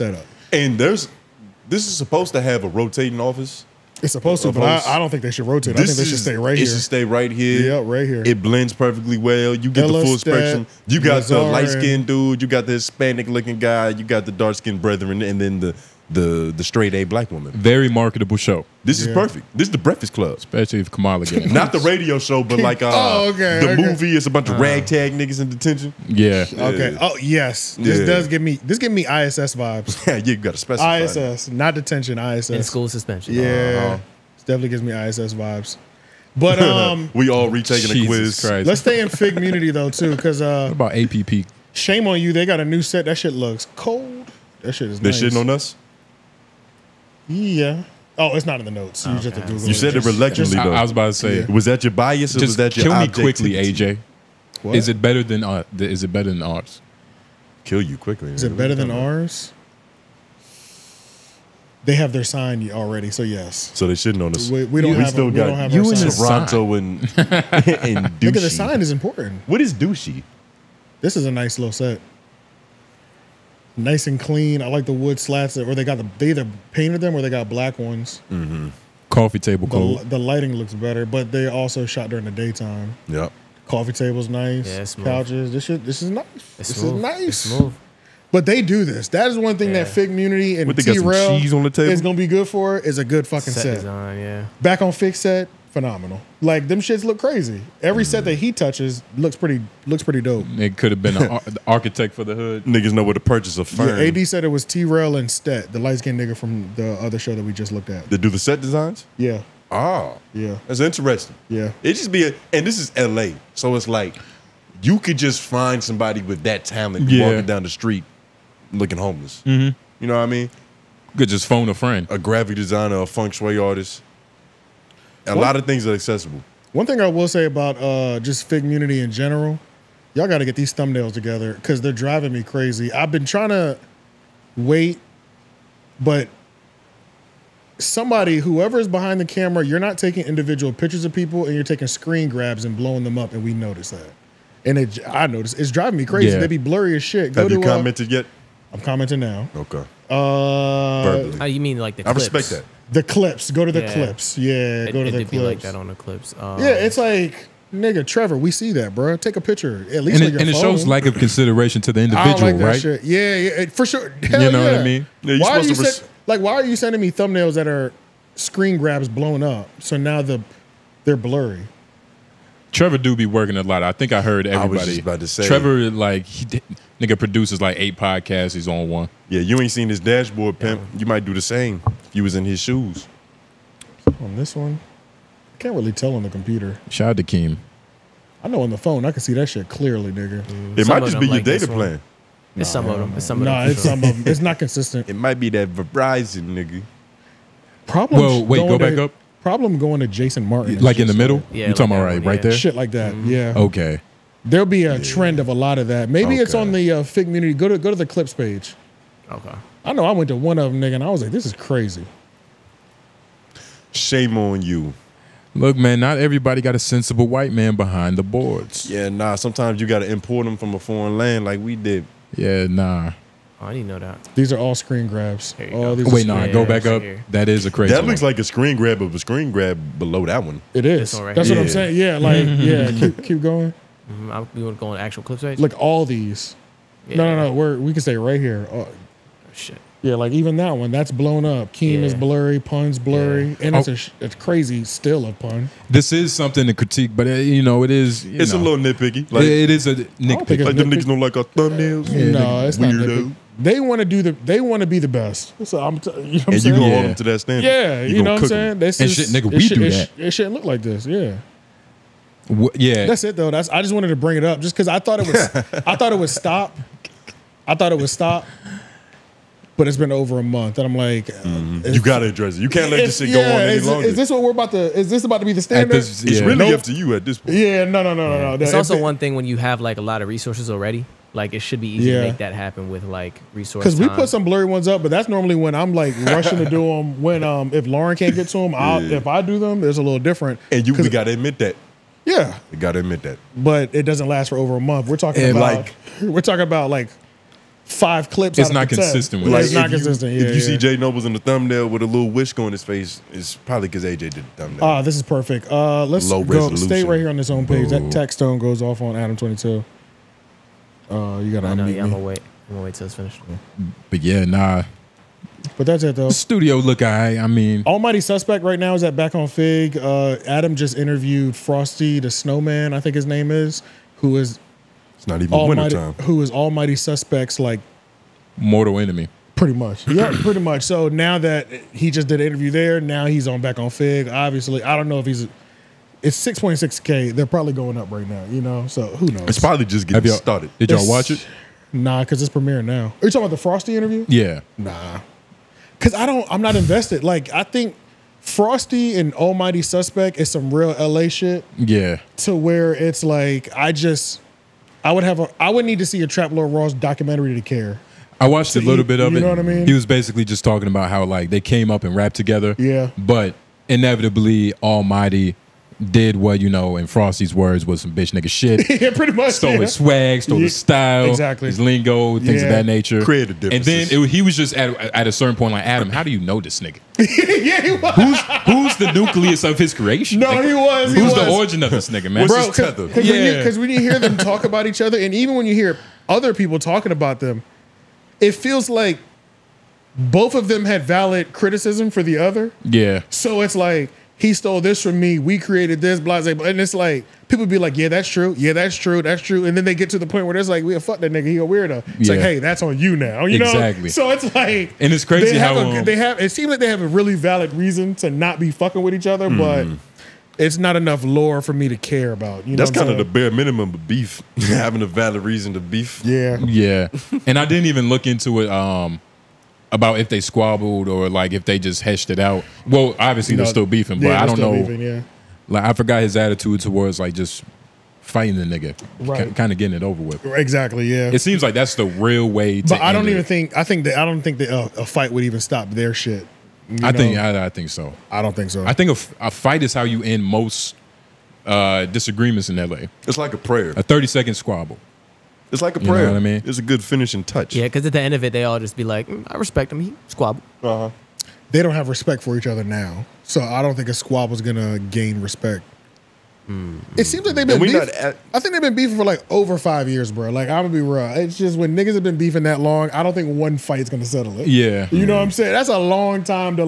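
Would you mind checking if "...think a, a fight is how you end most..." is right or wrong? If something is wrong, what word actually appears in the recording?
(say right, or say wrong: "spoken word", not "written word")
right.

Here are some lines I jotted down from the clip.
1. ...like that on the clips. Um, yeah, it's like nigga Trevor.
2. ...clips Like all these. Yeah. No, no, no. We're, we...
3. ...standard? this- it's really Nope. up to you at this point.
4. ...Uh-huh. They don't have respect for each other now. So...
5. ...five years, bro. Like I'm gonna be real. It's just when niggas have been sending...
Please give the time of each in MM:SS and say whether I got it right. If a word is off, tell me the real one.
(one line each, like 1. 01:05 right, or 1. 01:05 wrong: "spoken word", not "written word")
1. 02:35 right
2. 03:55 right
3. 04:35 right
4. 07:30 right
5. 07:39 wrong: "beefing", not "sending".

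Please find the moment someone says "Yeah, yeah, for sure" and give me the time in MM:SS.
02:43.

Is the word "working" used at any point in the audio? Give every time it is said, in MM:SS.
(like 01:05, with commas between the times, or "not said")
02:53.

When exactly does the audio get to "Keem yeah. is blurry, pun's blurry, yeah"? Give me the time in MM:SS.
04:01.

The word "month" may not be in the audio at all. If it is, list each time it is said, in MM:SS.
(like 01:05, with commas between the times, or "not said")
04:30, 04:54.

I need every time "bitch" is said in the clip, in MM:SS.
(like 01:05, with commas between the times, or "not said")
06:08.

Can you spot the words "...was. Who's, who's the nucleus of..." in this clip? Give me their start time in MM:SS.
06:17.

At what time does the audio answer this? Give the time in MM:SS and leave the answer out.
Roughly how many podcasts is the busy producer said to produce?
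02:57.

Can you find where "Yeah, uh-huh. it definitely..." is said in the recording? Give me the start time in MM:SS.
00:33.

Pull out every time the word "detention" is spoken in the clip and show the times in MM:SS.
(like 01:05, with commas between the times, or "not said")
00:25, 00:31.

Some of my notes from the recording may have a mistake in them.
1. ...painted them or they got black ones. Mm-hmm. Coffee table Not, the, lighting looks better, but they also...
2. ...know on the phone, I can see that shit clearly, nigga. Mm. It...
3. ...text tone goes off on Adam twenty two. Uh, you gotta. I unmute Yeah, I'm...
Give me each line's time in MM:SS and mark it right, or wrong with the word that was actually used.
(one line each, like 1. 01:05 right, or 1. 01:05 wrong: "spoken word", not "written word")
1. 01:16 wrong: "The", not "Not"
2. 03:08 right
3. 05:08 right.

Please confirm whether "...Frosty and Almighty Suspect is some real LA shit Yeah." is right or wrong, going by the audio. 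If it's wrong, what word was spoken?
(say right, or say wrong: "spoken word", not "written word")
right.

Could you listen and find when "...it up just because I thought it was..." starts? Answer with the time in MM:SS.
04:24.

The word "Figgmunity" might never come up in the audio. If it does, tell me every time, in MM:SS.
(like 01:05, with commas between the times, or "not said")
01:29, 02:08, 03:27.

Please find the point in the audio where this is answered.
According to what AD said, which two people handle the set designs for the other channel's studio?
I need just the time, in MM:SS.
01:44.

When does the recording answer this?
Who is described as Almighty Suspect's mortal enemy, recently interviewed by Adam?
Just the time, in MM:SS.
05:21.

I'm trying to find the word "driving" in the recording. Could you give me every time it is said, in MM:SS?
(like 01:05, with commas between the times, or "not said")
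02:11, 02:25.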